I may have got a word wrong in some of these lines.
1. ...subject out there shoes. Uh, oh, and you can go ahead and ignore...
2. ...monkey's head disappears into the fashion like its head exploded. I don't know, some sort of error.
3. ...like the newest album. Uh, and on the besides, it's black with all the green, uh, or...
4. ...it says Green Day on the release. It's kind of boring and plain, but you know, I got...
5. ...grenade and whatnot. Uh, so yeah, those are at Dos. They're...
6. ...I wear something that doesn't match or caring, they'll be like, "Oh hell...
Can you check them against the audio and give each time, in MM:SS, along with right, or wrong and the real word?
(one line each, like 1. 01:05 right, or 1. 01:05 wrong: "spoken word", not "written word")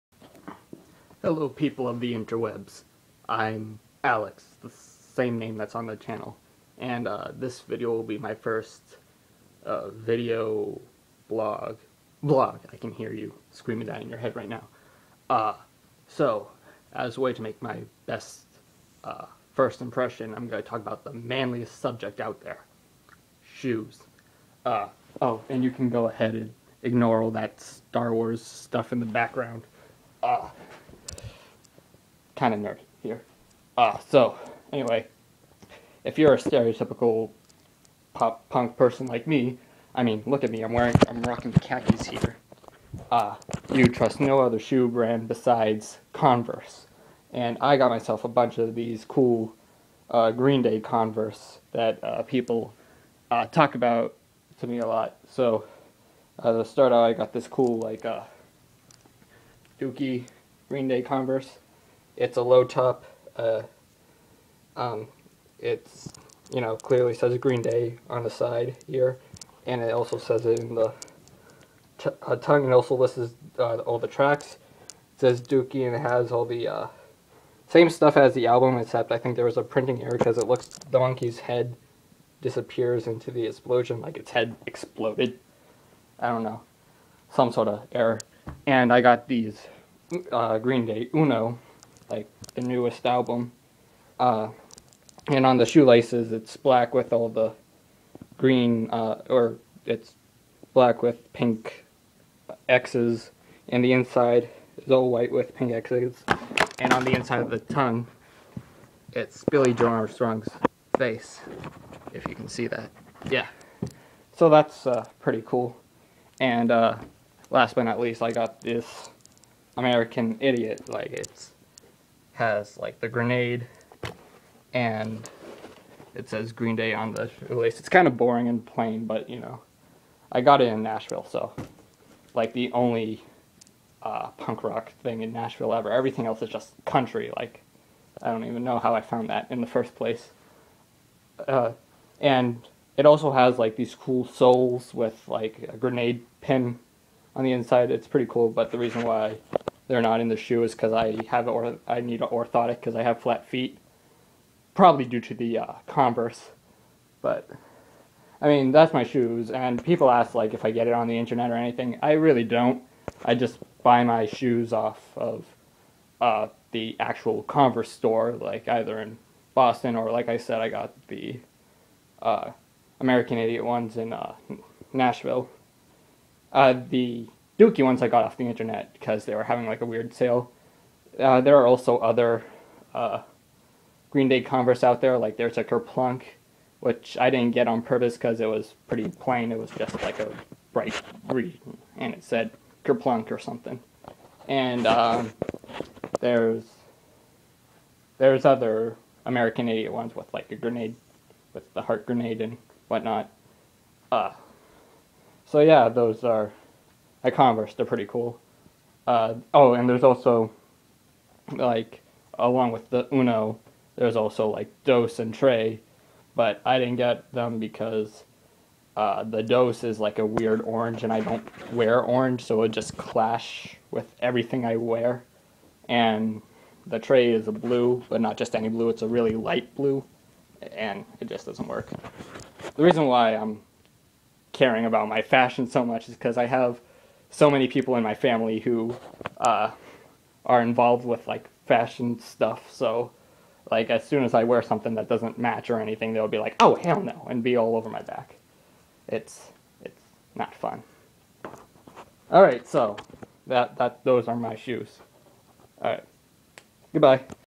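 1. 00:21 right
2. 01:20 wrong: "explosion", not "fashion"
3. 01:32 wrong: "shoelaces", not "besides"
4. 02:06 right
5. 03:22 wrong: "Converse", not "Dos"
6. 04:04 wrong: "anything", not "caring".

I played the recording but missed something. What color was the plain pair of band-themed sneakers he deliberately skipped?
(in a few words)
Bright green.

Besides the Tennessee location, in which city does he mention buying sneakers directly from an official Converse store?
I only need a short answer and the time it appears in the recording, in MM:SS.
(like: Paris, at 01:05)
Boston, at 02:49.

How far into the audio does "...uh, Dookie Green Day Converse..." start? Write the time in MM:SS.
00:58.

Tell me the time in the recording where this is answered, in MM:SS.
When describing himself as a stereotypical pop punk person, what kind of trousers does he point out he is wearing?
00:41.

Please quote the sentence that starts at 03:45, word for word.
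And the Tré is a blue, but not just any blue; it's a really light blue, and it just doesn't work.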